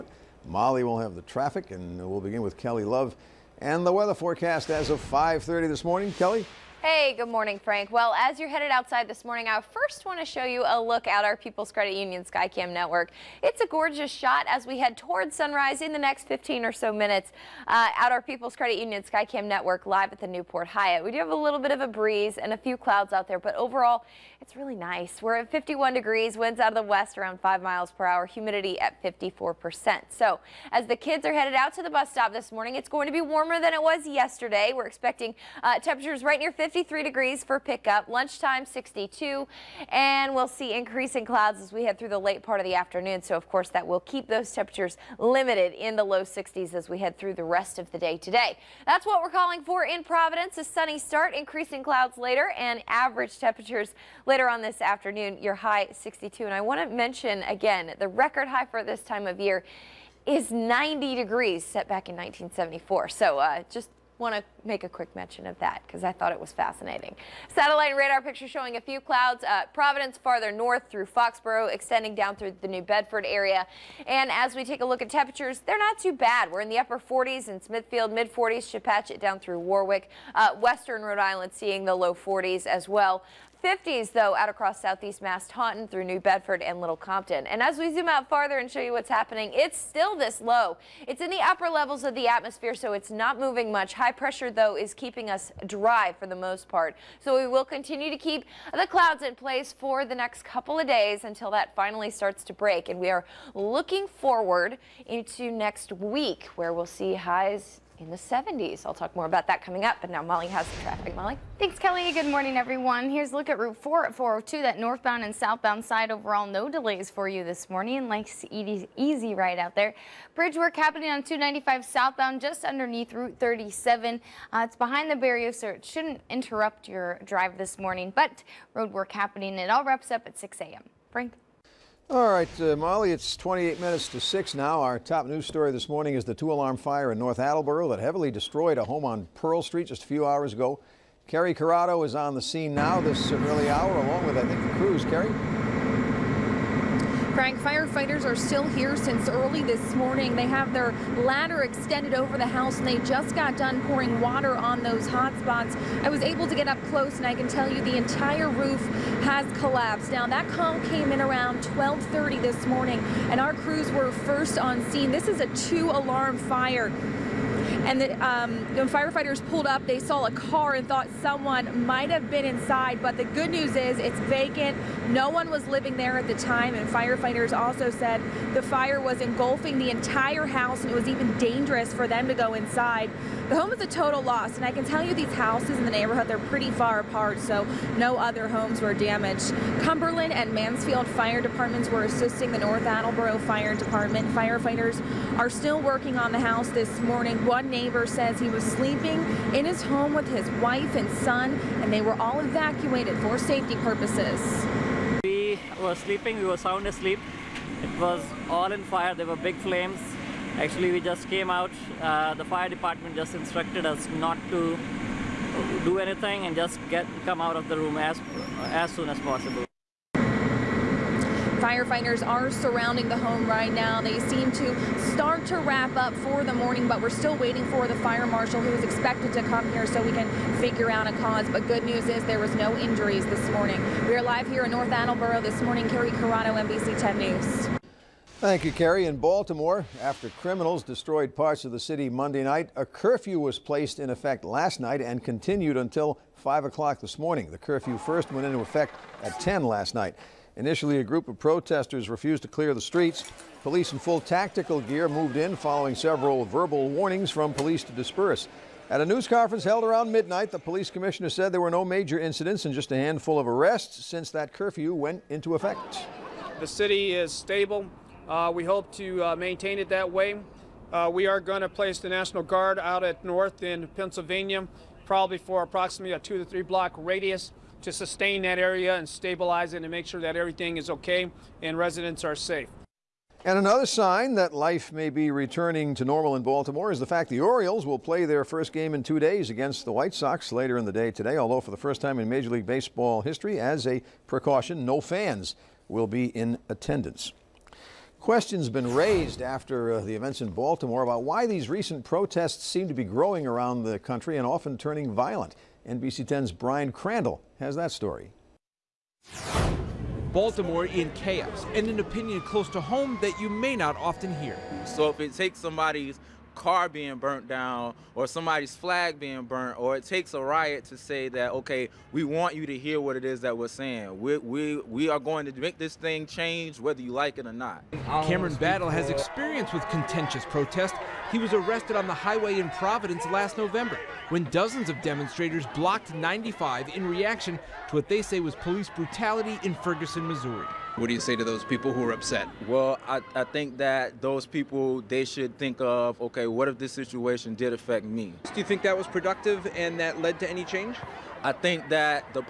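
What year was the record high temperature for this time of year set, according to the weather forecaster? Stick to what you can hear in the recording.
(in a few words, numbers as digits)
1974.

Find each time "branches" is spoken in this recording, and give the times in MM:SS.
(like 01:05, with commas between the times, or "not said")
not said.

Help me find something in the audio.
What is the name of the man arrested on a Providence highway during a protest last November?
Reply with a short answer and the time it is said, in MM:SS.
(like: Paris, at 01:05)
Cameron Battle, at 05:28.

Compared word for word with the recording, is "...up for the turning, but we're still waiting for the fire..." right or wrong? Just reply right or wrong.
wrong.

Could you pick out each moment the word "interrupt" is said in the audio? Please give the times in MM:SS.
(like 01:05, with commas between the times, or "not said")
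02:06.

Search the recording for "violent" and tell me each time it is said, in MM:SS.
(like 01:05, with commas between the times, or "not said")
05:05.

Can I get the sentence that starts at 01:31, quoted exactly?
It's in the upper levels of the atmosphere, so it's not moving much.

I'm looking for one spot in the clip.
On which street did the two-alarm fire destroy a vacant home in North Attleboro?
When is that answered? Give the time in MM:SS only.
02:19.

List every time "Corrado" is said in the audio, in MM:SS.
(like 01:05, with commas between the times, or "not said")
02:21, 03:56.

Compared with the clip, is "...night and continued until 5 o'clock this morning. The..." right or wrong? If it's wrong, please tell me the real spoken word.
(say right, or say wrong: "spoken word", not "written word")
right.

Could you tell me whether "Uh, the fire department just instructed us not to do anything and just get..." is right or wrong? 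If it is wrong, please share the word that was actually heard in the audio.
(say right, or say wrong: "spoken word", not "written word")
right.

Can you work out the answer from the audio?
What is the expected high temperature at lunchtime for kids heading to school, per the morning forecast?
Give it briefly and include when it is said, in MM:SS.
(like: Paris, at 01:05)
62, at 00:38.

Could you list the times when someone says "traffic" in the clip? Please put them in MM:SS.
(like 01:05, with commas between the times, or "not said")
00:01, 01:50.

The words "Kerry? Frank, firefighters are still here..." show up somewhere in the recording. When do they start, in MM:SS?
02:25.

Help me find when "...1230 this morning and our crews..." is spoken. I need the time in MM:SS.
02:41.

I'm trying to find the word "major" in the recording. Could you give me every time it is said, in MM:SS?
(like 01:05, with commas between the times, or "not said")
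04:21, 04:52.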